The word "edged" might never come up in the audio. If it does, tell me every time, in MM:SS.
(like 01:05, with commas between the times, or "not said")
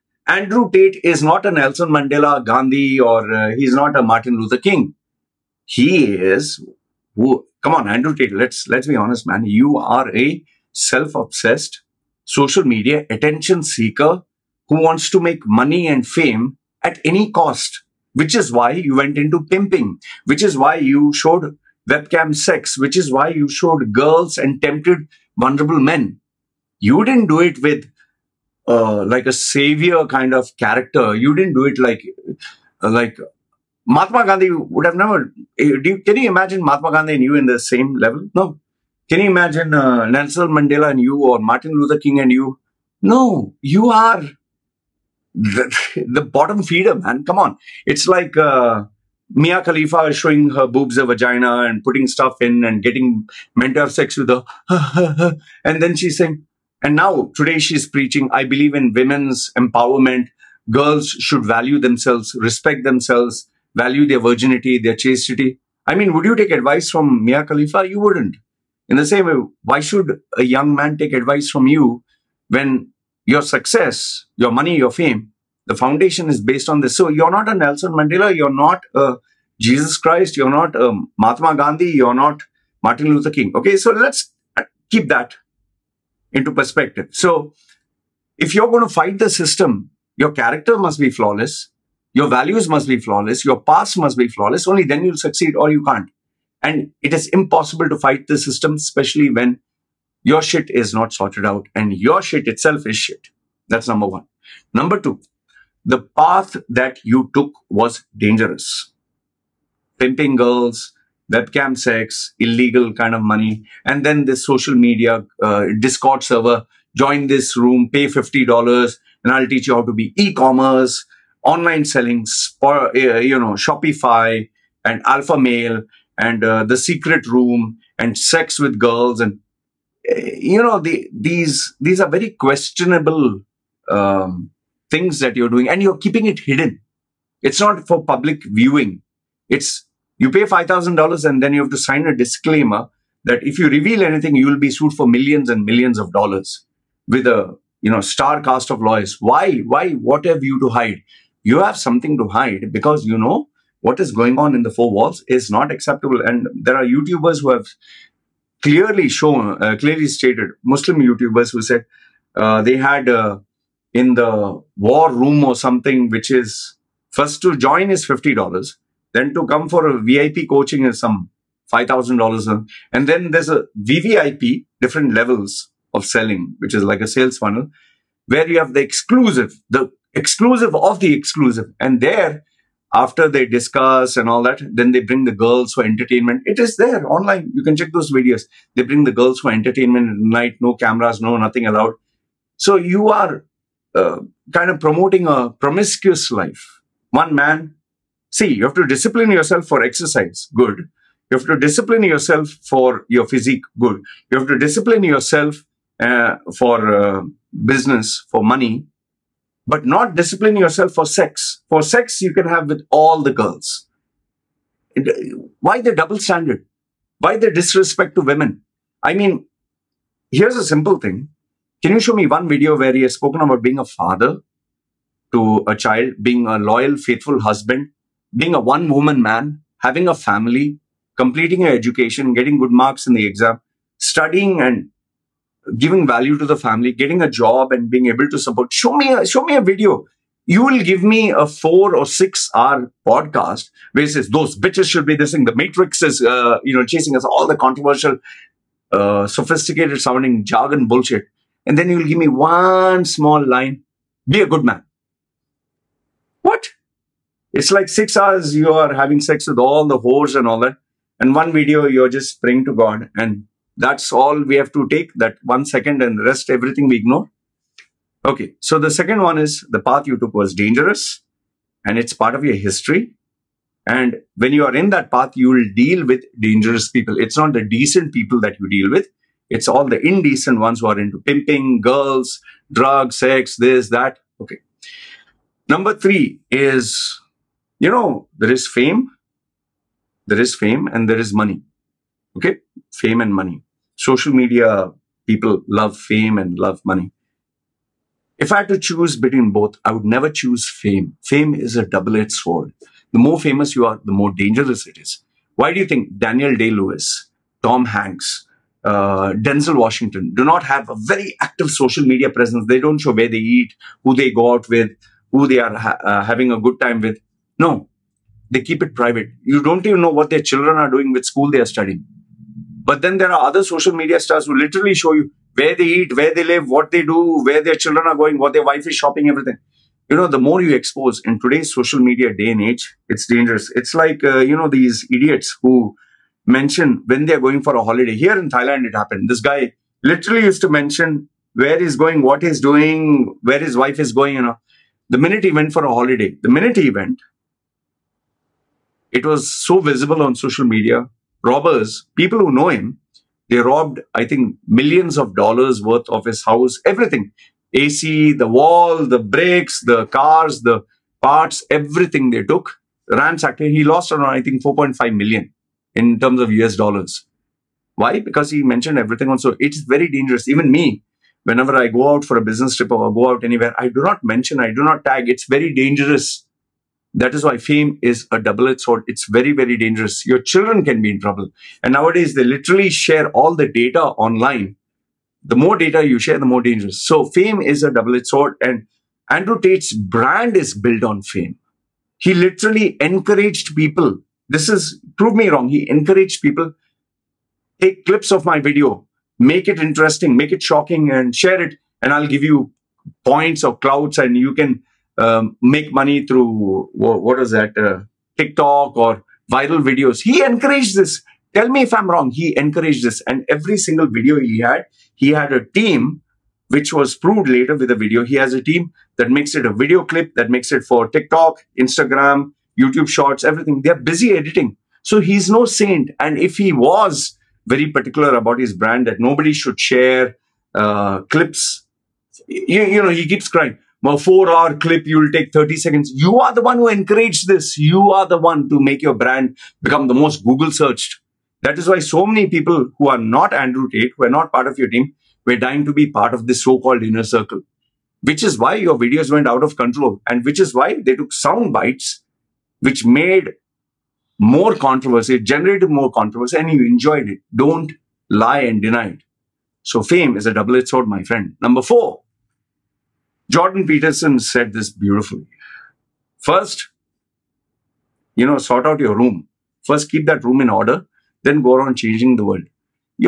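05:01, 06:18, 06:27, 07:40.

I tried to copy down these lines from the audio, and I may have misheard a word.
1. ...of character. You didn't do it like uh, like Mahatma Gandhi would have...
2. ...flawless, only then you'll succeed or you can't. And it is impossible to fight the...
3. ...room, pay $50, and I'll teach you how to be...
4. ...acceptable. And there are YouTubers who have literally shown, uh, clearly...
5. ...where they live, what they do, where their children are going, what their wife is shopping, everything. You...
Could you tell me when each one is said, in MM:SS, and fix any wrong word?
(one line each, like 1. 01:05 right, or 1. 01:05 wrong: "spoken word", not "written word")
1. 00:30 right
2. 01:34 right
3. 01:57 right
4. 02:35 wrong: "clearly", not "literally"
5. 05:26 right.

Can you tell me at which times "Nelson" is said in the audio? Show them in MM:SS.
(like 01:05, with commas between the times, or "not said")
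00:01, 00:40, 01:17.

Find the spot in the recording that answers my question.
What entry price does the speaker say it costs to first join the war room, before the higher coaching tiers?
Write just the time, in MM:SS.
02:47.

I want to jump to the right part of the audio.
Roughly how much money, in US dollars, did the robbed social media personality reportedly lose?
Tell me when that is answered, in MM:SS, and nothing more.
06:04.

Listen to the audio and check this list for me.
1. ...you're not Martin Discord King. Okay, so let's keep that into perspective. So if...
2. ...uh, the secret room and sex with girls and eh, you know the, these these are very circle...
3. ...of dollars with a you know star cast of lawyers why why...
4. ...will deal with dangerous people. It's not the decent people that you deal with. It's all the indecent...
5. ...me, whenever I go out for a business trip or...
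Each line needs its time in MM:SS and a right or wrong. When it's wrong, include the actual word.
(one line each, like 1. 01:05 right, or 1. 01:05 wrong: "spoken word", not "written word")
1. 01:21 wrong: "Luther", not "Discord"
2. 02:06 wrong: "questionable", not "circle"
3. 02:25 right
4. 04:35 right
5. 06:10 right.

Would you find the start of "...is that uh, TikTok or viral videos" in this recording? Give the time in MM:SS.
06:47.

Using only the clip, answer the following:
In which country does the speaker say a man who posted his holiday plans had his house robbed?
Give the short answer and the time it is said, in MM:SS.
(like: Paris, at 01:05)
Thailand, at 05:38.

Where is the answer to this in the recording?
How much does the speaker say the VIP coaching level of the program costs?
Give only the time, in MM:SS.
02:50.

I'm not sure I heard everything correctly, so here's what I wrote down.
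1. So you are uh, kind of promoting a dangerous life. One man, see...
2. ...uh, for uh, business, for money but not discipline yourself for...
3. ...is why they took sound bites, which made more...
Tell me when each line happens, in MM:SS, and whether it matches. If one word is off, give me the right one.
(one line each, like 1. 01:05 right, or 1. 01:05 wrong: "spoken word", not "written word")
1. 03:12 wrong: "promiscuous", not "dangerous"
2. 03:26 right
3. 07:30 right.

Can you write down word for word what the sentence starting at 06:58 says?
He has a team that makes it a video clip, that makes it for TikTok, Instagram, YouTube Shorts, everything.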